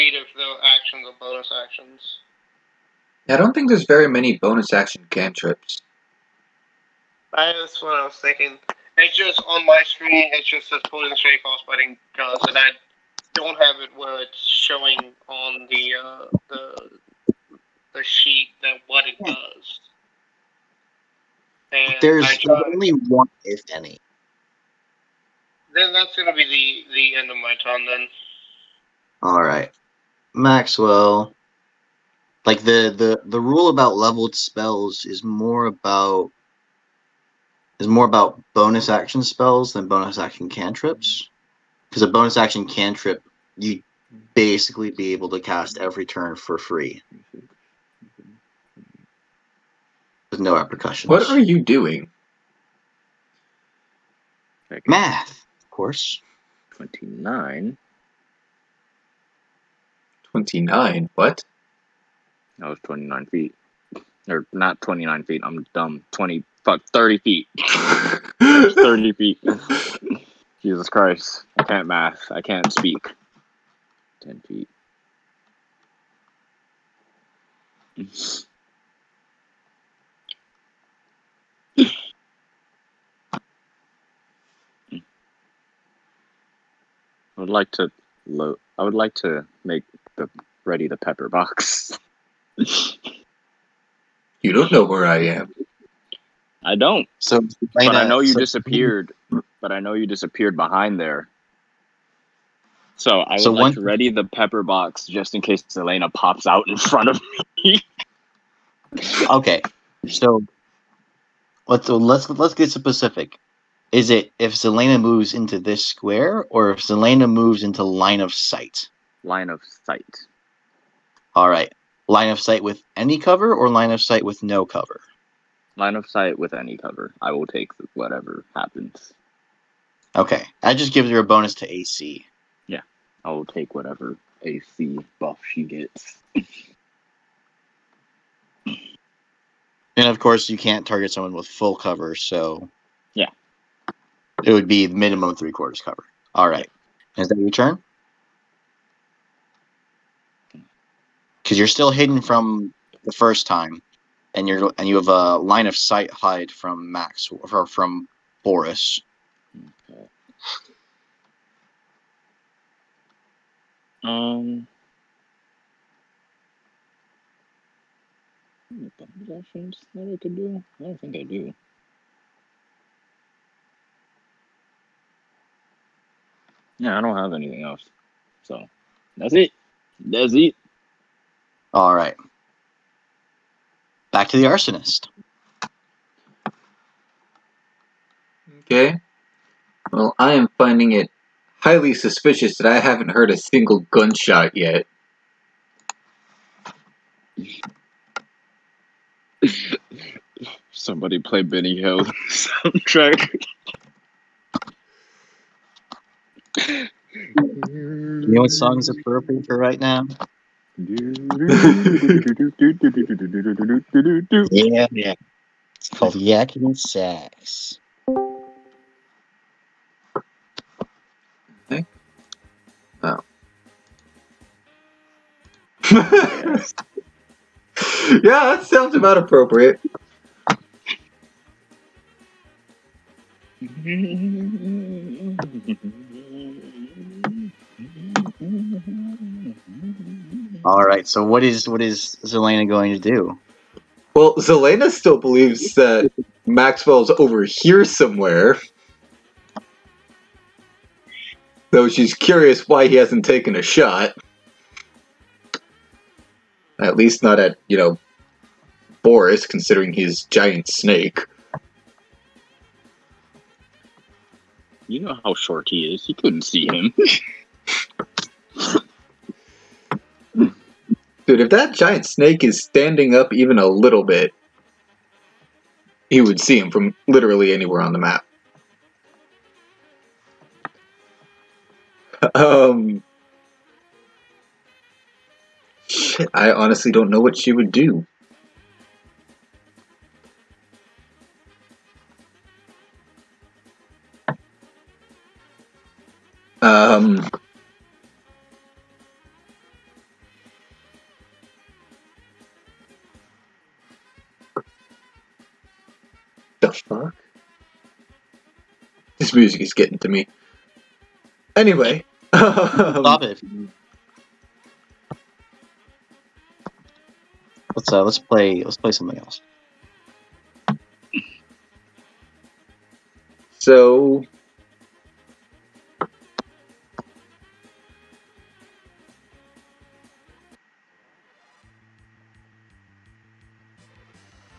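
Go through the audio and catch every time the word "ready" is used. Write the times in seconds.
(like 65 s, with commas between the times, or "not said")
90 s, 103 s.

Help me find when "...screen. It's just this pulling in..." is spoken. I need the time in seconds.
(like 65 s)
9 s.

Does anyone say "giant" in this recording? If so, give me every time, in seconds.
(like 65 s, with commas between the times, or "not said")
260 s, 271 s.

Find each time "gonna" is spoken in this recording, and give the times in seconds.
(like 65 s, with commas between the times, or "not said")
26 s.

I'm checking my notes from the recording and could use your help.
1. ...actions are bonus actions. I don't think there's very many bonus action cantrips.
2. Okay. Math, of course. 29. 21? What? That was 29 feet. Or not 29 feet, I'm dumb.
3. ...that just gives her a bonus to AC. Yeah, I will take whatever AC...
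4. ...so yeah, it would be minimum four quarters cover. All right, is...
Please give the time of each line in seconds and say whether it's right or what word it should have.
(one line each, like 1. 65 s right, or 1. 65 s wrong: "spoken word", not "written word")
1. 0 s right
2. 54 s wrong: "29", not "21"
3. 130 s right
4. 142 s wrong: "three", not "four".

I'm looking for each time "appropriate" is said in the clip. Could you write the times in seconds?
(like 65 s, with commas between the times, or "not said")
208 s, 229 s.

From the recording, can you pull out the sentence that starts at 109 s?
okay, so let's let's let's get specific.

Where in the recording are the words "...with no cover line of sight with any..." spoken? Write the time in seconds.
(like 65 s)
124 s.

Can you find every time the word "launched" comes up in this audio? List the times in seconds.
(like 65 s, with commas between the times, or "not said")
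not said.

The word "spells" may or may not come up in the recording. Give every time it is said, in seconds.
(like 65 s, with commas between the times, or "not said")
34 s, 39 s.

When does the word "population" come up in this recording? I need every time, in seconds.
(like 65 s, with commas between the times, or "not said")
not said.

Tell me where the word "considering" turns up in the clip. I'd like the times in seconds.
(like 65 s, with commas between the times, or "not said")
259 s.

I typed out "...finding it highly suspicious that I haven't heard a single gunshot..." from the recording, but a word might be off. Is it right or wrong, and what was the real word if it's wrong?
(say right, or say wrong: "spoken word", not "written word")
right.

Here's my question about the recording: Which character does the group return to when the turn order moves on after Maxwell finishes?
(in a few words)
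the arsonist.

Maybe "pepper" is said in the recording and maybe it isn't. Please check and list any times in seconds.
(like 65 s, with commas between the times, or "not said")
90 s, 104 s.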